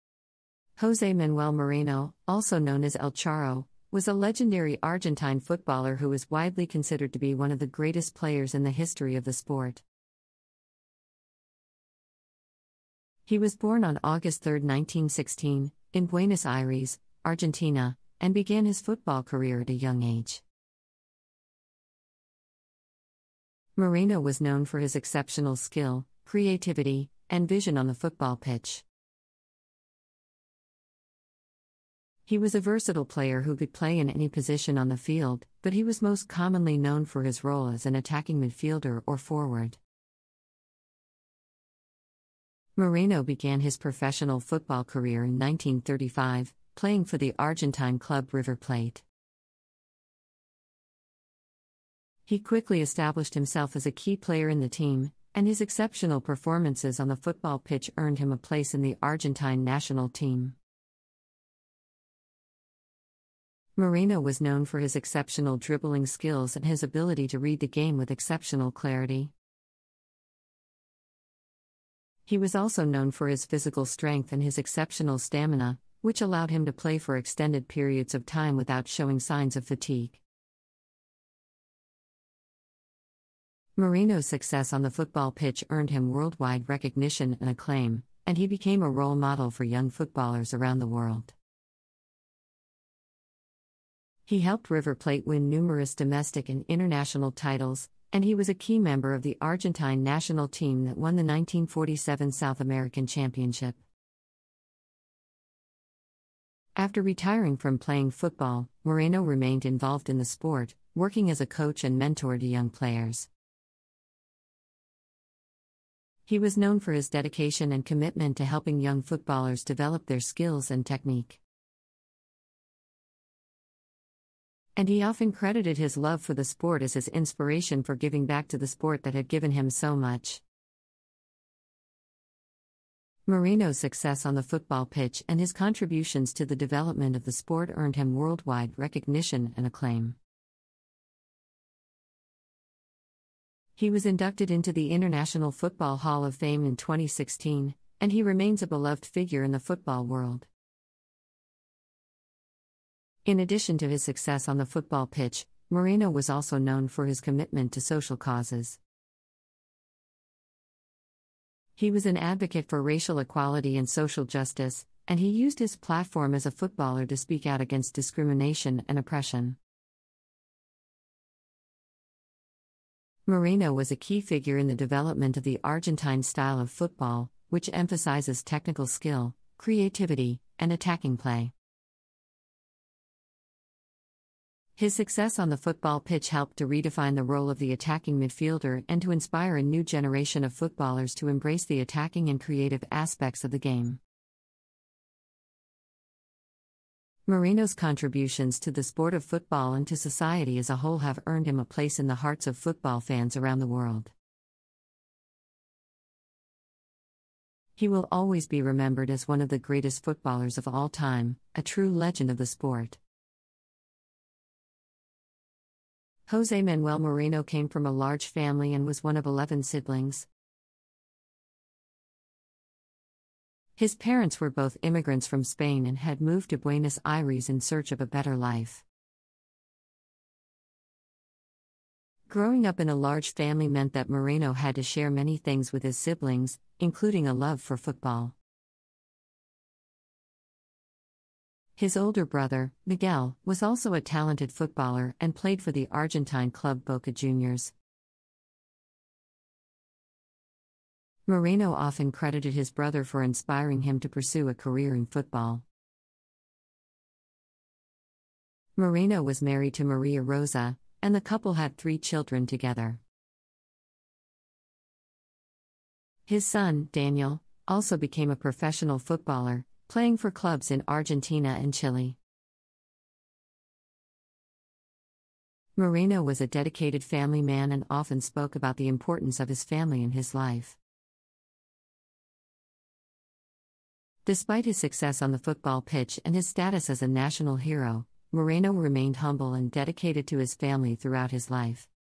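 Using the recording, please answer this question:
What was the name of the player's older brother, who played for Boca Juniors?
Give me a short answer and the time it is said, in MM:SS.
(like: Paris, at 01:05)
Miguel, at 04:02.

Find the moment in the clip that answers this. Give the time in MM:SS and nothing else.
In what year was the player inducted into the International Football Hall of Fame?
02:26.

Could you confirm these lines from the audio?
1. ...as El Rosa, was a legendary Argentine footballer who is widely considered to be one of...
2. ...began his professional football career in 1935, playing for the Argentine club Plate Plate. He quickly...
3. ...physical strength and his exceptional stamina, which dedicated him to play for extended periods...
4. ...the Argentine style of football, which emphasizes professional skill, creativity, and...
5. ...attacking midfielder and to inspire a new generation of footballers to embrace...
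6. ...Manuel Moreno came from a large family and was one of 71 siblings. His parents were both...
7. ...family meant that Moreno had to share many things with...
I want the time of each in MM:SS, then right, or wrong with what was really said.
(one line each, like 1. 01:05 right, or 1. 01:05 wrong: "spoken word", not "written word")
1. 00:02 wrong: "Charro", not "Rosa"
2. 00:43 wrong: "River", not "Plate"
3. 01:13 wrong: "allowed", not "dedicated"
4. 02:55 wrong: "technical", not "professional"
5. 03:07 right
6. 03:36 wrong: "11", not "71"
7. 03:53 right.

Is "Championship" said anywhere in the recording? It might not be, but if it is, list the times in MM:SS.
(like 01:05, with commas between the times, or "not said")
01:43.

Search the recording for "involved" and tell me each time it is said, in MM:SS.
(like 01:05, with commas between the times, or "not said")
01:49.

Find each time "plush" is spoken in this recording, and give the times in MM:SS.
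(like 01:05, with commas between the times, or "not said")
not said.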